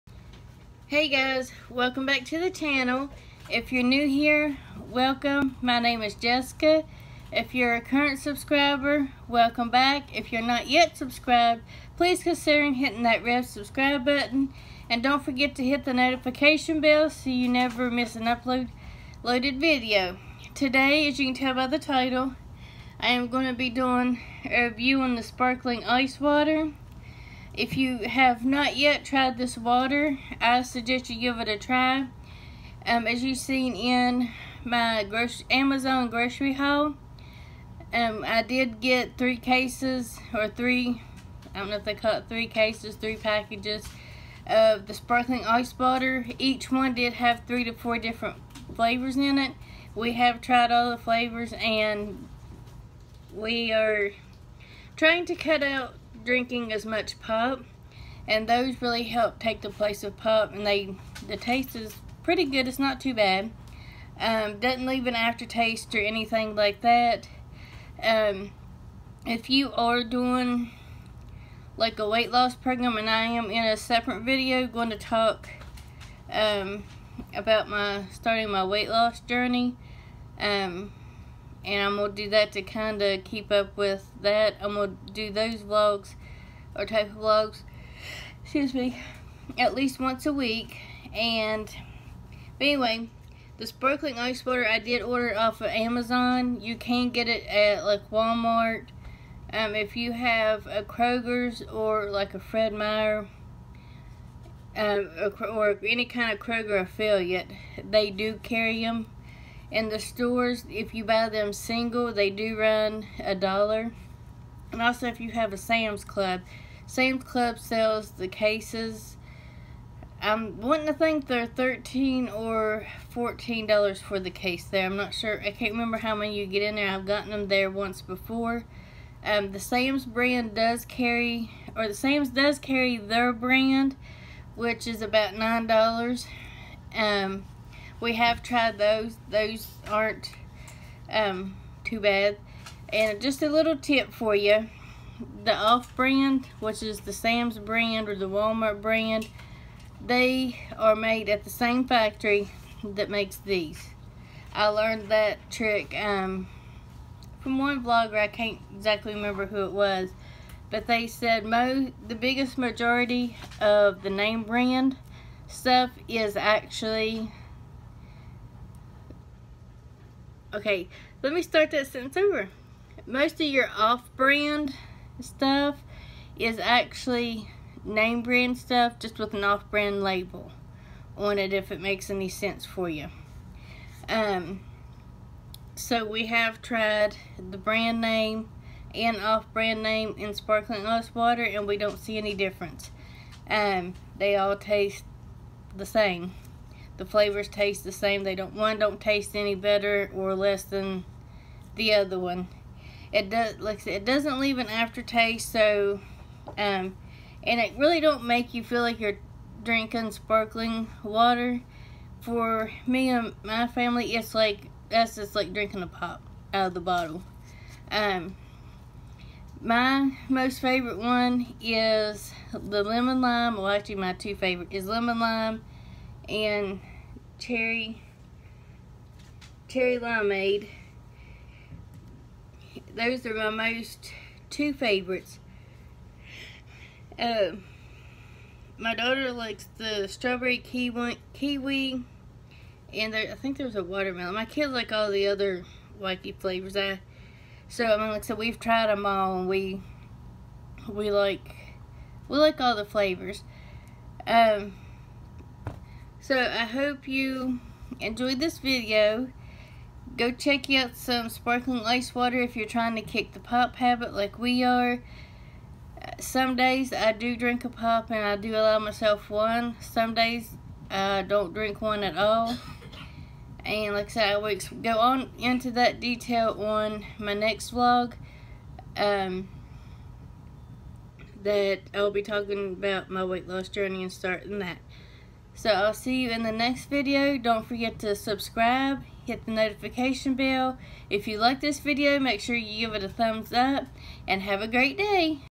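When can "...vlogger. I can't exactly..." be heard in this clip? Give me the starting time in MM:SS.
02:37.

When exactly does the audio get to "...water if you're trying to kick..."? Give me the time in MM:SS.
04:22.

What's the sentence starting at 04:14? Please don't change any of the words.
Um, so I hope you enjoyed this video.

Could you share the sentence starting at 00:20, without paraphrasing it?
Today, as you can tell by the title, I am going to be doing a review on the sparkling ice water.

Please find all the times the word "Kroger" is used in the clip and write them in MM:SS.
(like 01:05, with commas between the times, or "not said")
01:40, 01:46.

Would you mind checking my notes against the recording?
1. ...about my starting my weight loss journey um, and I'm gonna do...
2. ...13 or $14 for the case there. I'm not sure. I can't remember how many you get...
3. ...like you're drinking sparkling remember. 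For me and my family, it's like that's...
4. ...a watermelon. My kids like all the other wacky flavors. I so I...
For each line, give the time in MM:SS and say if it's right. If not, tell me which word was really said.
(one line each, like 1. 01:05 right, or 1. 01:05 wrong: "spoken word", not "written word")
1. 01:17 right
2. 02:01 right
3. 03:28 wrong: "water", not "remember"
4. 04:03 right.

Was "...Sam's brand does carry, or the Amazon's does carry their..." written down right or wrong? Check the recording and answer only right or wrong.
wrong.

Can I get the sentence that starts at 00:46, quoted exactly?
Each one did have three to four different flavors in it.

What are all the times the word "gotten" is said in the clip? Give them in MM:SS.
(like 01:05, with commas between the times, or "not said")
02:07.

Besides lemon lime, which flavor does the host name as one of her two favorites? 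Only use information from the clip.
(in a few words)
Cherry limeade.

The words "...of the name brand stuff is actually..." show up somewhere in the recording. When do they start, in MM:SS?
02:43.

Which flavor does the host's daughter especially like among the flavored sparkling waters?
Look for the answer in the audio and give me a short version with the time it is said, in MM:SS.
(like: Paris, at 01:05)
Strawberry kiwi, at 04:00.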